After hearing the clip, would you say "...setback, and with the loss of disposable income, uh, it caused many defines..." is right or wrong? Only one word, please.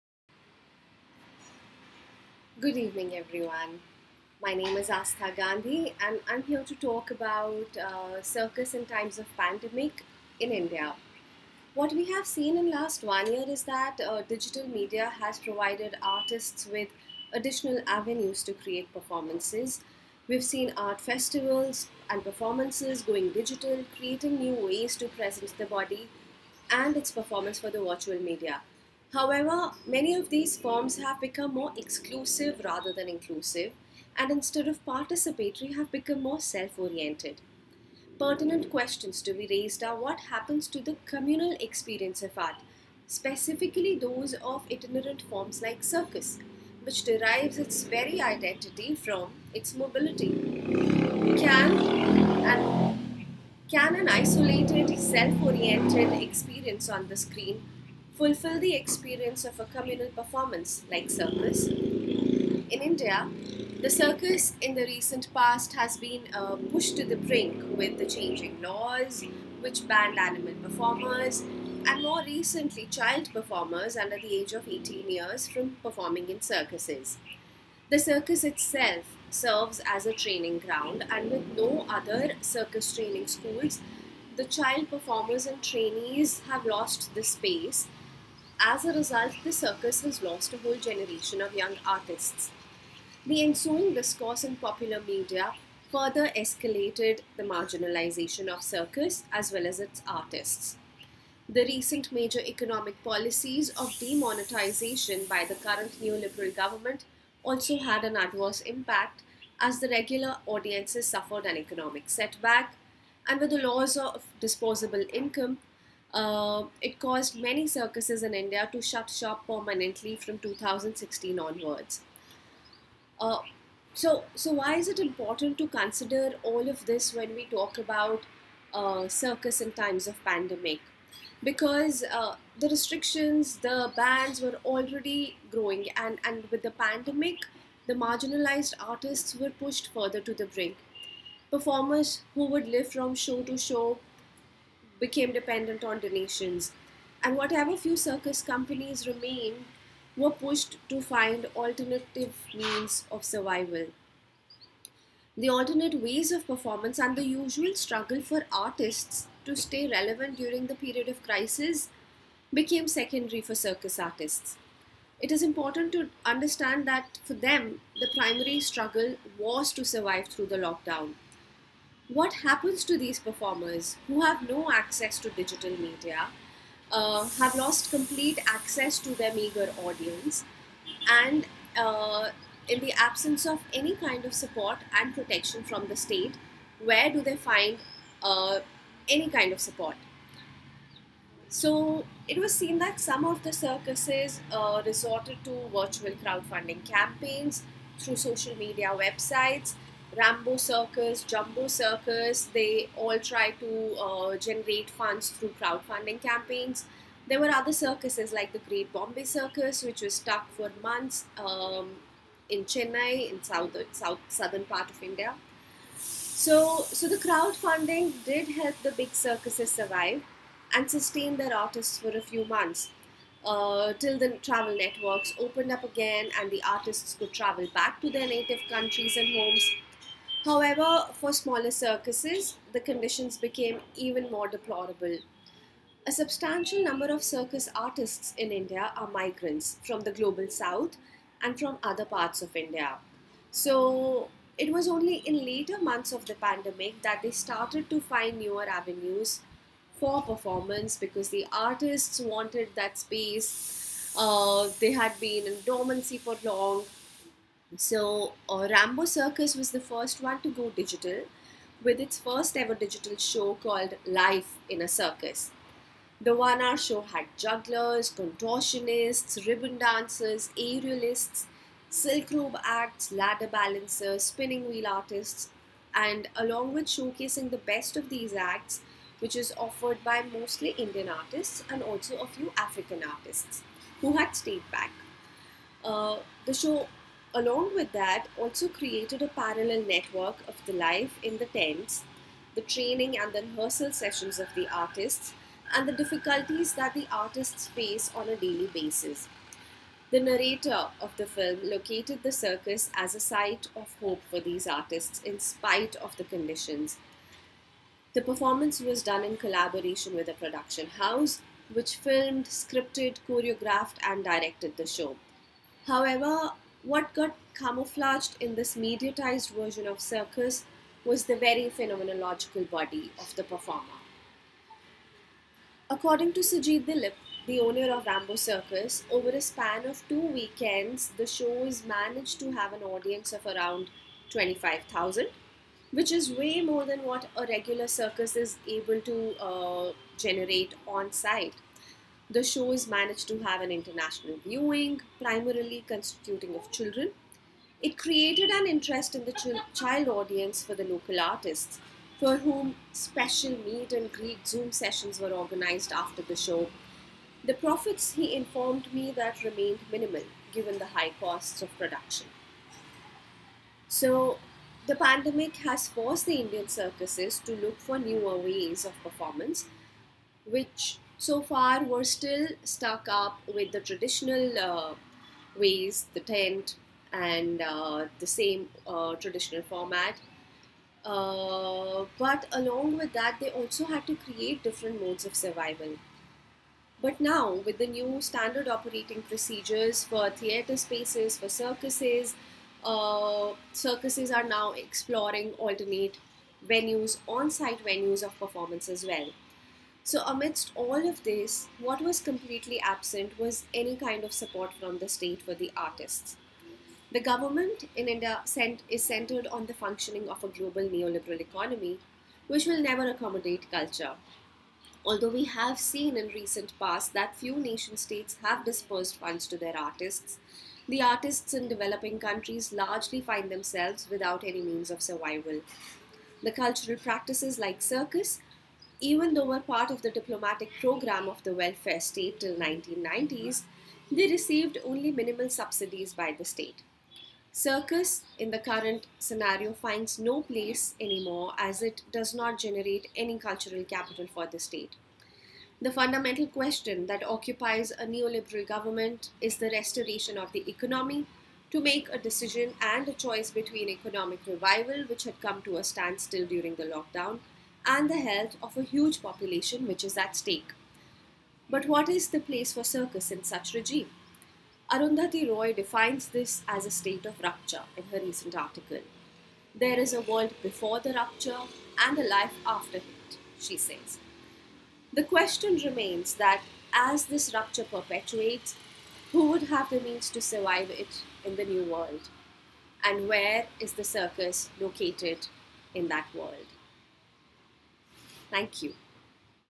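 wrong.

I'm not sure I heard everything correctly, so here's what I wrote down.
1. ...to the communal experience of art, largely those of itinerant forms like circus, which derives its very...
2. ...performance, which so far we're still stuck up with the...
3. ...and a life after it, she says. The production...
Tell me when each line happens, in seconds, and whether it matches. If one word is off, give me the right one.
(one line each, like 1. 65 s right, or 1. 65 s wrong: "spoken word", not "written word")
1. 40 s wrong: "specifically", not "largely"
2. 369 s right
3. 472 s wrong: "question", not "production".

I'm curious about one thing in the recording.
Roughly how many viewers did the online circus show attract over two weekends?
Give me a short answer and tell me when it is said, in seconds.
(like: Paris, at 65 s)
25,000, at 334 s.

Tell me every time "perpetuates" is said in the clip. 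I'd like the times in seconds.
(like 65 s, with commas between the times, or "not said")
477 s.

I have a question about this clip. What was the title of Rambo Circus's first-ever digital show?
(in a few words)
Life in a Circus.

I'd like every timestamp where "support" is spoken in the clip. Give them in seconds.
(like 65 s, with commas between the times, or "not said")
184 s, 189 s, 404 s.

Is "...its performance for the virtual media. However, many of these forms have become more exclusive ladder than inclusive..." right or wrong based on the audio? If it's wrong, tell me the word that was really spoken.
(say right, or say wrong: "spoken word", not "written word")
wrong: "rather", not "ladder".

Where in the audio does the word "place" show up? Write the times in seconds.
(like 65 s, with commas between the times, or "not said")
440 s, 462 s.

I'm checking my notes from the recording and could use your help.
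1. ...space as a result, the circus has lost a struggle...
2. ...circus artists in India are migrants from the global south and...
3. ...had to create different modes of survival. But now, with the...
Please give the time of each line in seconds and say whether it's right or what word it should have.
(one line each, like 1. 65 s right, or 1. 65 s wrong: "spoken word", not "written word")
1. 87 s wrong: "whole", not "struggle"
2. 237 s right
3. 383 s right.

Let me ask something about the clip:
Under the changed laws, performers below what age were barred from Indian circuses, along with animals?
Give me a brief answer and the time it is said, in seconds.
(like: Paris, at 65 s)
18, at 74 s.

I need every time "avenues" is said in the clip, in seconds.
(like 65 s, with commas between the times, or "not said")
17 s, 248 s.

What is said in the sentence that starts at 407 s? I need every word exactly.
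The government in India is centered on the functioning of a global neoliberal economy, which will never accommodate culture.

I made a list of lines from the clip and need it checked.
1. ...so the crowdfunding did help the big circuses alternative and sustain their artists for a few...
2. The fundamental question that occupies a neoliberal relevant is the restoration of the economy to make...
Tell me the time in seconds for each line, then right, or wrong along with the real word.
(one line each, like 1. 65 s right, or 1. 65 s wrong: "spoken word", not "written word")
1. 216 s wrong: "survive", not "alternative"
2. 445 s wrong: "government", not "relevant".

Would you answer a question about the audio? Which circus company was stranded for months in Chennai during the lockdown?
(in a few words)
Great Bombay Circus.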